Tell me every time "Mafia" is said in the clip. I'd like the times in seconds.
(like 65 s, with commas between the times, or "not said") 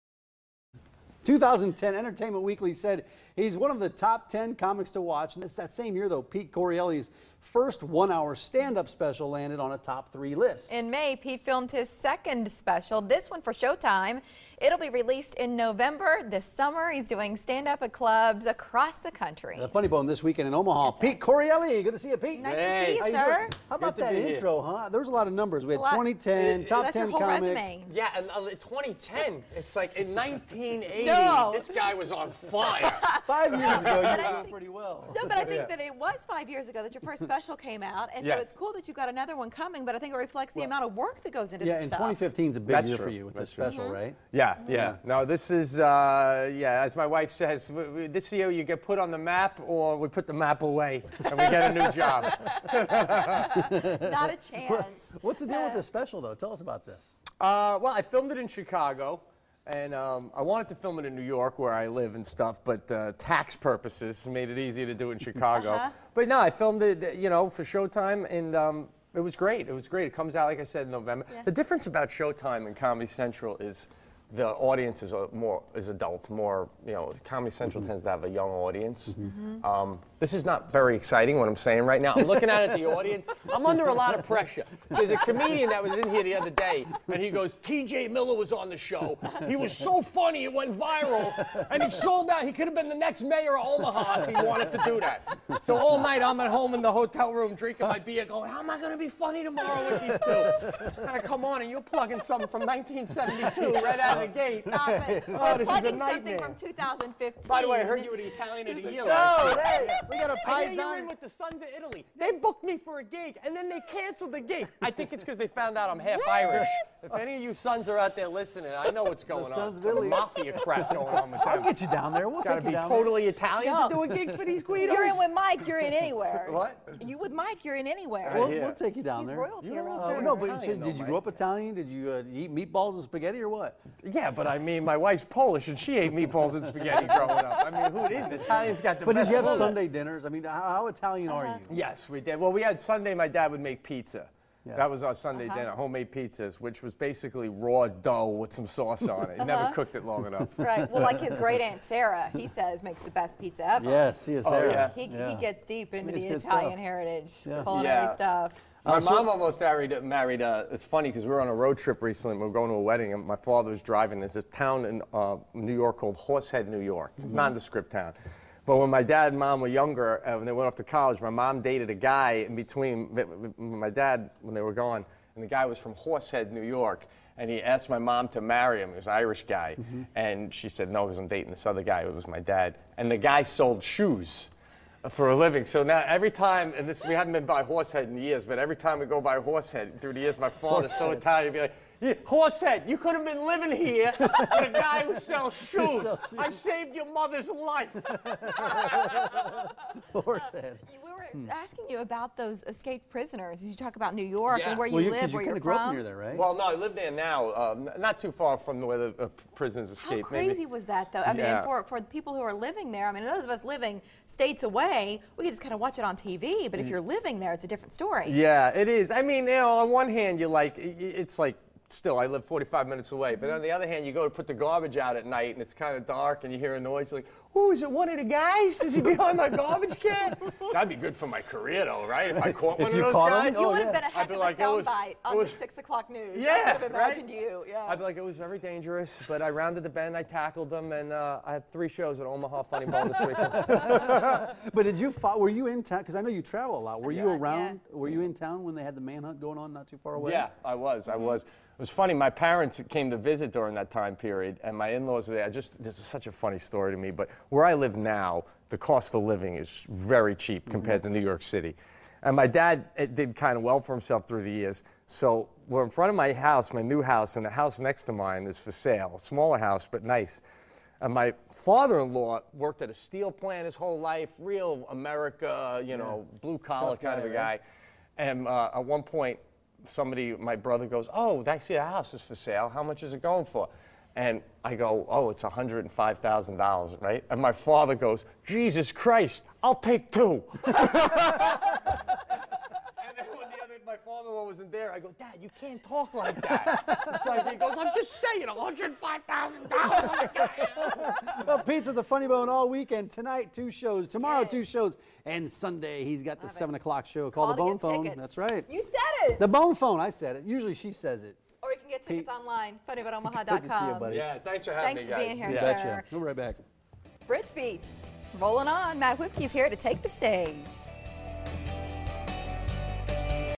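120 s.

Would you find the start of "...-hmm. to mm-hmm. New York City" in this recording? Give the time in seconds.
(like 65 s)
261 s.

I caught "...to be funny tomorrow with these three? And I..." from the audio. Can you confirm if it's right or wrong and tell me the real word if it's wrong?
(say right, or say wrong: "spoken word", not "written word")
wrong: "two", not "three".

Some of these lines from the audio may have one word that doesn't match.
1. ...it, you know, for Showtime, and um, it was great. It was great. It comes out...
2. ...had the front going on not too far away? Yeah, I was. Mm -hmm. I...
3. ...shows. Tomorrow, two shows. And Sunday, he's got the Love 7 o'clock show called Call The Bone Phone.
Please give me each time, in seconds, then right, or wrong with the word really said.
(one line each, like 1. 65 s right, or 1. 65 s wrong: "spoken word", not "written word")
1. 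66 s right
2. 248 s wrong: "manhunt", not "front"
3. 303 s right.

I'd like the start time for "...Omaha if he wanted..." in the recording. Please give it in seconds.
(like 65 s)
93 s.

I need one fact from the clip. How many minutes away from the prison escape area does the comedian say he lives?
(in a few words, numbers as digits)
45.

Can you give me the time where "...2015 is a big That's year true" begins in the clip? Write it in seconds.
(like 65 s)
42 s.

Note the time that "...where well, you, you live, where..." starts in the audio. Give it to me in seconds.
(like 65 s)
204 s.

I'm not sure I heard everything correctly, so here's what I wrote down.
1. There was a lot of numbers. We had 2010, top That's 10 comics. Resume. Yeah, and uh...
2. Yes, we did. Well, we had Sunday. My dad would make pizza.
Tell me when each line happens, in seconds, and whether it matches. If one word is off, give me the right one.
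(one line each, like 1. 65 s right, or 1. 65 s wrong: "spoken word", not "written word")
1. 24 s right
2. 141 s right.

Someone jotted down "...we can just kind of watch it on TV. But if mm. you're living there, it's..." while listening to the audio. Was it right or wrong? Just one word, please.
right.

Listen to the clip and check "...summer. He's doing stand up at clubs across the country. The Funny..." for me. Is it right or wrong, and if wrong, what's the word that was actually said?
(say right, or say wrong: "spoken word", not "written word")
right.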